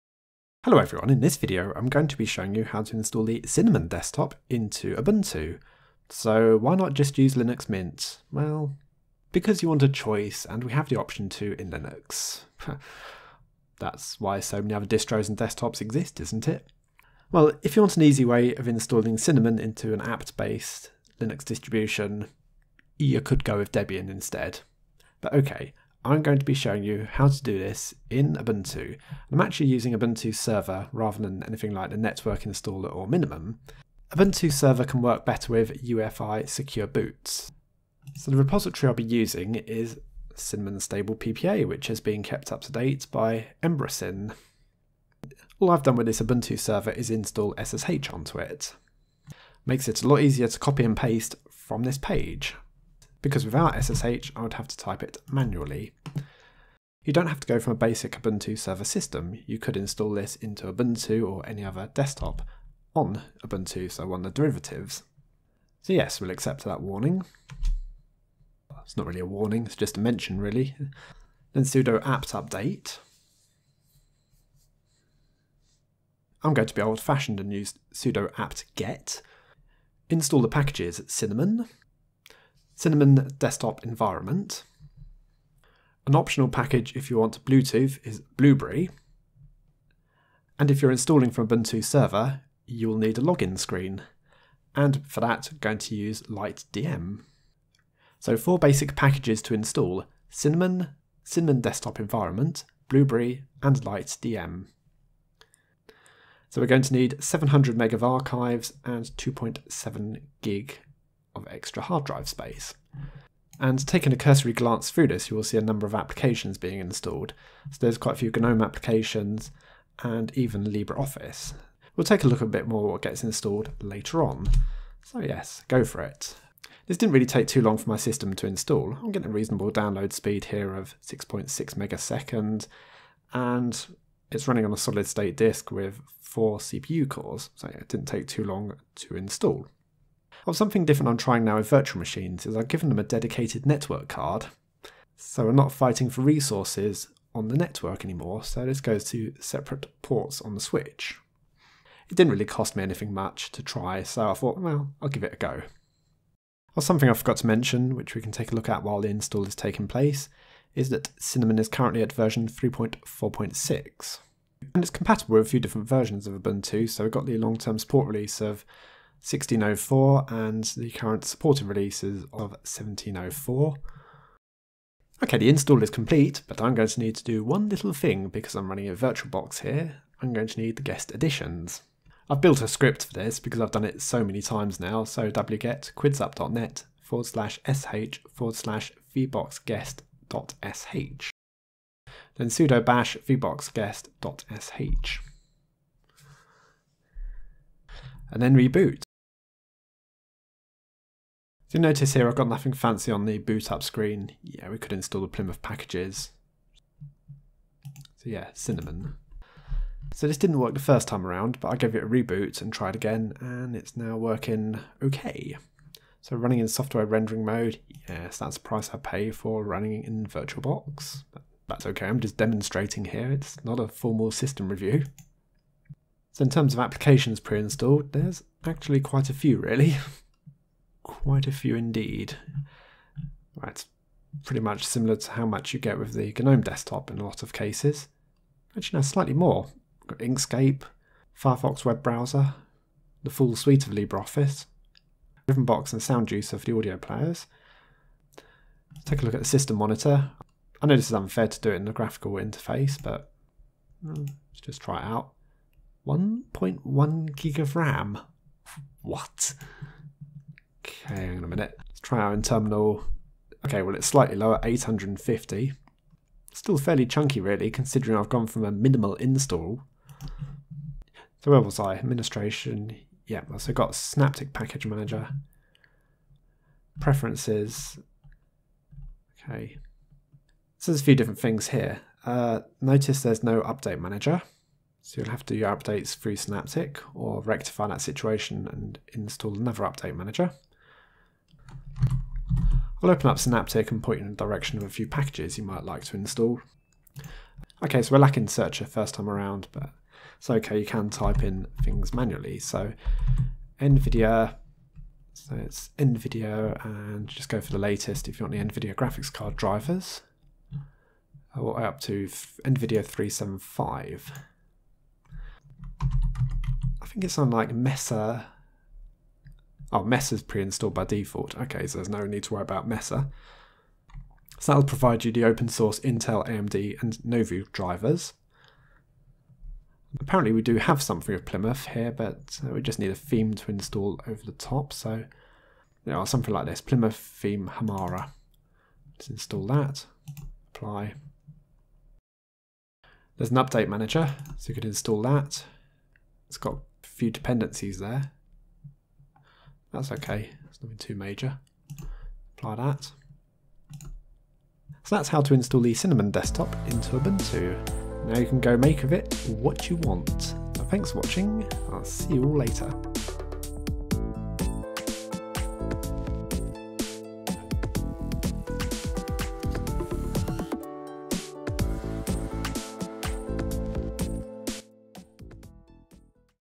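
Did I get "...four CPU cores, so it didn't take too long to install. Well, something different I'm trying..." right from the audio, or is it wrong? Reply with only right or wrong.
right.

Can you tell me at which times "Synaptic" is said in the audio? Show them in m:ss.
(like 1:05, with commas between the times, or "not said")
4:33, 4:46, 4:53.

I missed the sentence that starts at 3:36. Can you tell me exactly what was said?
So running in software rendering mode, yes, that's the price I pay for running in VirtualBox.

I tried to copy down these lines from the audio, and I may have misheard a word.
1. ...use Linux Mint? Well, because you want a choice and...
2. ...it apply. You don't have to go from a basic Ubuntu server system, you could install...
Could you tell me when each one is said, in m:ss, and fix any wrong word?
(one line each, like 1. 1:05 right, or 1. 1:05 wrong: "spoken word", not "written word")
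1. 0:07 right
2. 0:55 wrong: "manually", not "apply".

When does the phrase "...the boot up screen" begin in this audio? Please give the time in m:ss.
3:23.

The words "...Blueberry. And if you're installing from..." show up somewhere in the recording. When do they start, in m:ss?
1:28.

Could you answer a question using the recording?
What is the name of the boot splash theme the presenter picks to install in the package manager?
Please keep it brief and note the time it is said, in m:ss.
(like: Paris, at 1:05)
Hamara, at 5:37.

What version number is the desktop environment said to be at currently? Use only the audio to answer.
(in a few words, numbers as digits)
3.4.6.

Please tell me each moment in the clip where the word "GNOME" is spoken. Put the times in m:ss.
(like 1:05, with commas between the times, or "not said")
1:58, 3:56.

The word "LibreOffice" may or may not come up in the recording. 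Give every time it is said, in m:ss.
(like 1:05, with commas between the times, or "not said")
2:00, 4:03.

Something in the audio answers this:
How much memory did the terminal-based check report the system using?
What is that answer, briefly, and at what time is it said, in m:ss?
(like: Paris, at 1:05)
850, at 4:24.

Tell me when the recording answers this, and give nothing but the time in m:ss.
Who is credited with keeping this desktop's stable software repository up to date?
0:43.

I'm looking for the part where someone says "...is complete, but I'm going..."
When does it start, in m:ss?
2:55.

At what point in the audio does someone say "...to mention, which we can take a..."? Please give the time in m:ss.
2:37.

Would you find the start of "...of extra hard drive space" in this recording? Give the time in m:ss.
1:51.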